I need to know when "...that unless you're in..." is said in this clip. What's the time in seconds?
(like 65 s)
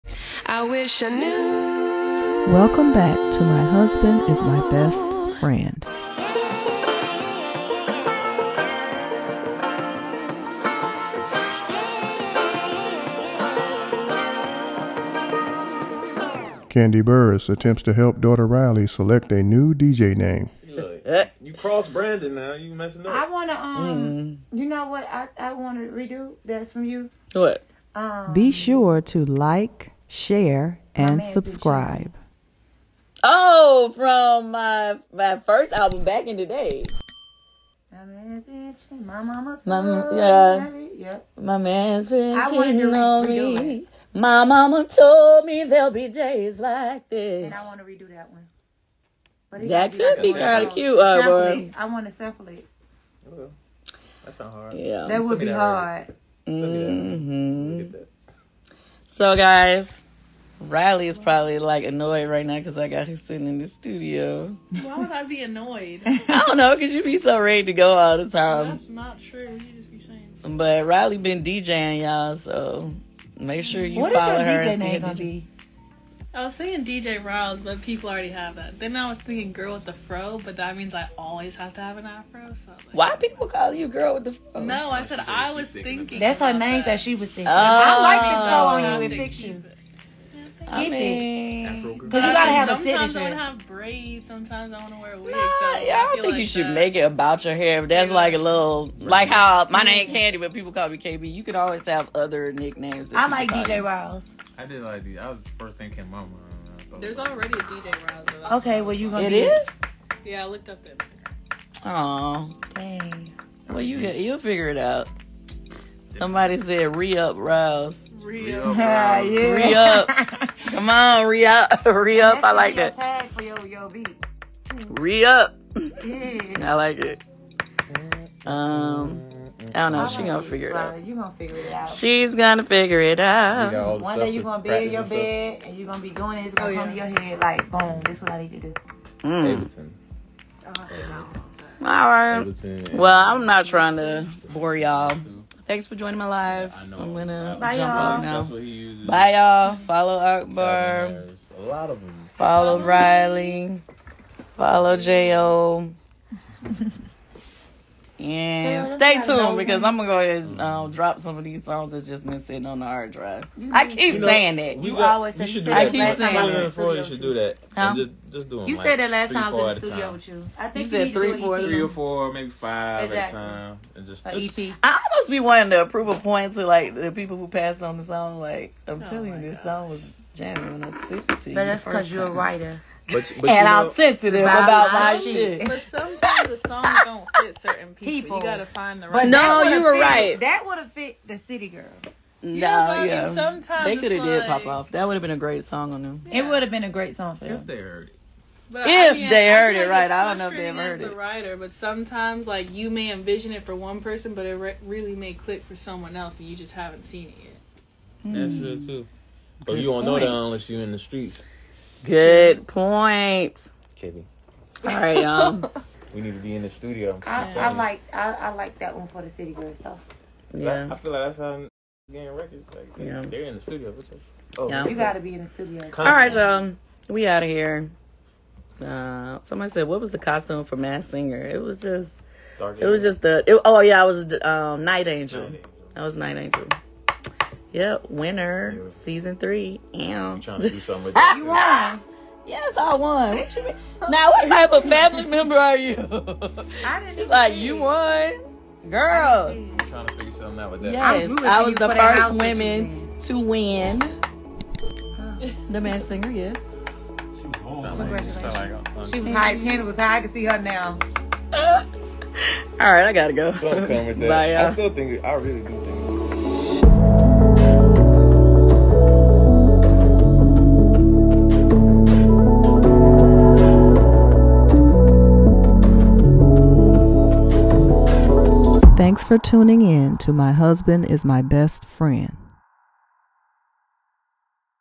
210 s.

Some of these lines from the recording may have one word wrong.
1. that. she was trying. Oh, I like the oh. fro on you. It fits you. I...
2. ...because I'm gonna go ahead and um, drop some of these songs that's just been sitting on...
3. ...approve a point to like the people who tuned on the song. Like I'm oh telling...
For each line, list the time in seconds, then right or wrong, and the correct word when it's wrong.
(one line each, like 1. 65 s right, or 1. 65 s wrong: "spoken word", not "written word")
1. 86 s wrong: "thinking", not "trying"
2. 159 s right
3. 175 s wrong: "passed", not "tuned".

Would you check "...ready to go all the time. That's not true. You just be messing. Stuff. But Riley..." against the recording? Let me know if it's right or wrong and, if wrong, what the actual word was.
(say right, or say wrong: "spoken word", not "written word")
wrong: "saying", not "messing".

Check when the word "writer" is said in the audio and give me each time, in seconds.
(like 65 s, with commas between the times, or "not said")
182 s, 201 s.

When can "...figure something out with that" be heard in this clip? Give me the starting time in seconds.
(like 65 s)
250 s.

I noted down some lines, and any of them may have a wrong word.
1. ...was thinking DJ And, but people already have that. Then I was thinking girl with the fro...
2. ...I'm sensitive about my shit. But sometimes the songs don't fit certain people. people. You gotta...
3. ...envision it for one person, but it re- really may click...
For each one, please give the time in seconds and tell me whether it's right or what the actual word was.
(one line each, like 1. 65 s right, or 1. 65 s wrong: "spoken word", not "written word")
1. 76 s wrong: "Riles", not "And"
2. 183 s right
3. 203 s right.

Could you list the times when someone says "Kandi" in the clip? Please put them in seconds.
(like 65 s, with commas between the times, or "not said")
16 s, 100 s.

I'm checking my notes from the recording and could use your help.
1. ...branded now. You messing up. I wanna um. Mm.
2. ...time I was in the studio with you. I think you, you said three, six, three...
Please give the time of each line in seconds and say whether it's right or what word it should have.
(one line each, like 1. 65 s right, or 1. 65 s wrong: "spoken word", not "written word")
1. 21 s right
2. 169 s wrong: "four", not "six".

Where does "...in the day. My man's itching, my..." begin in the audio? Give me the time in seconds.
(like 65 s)
36 s.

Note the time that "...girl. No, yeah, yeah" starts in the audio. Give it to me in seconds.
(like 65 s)
191 s.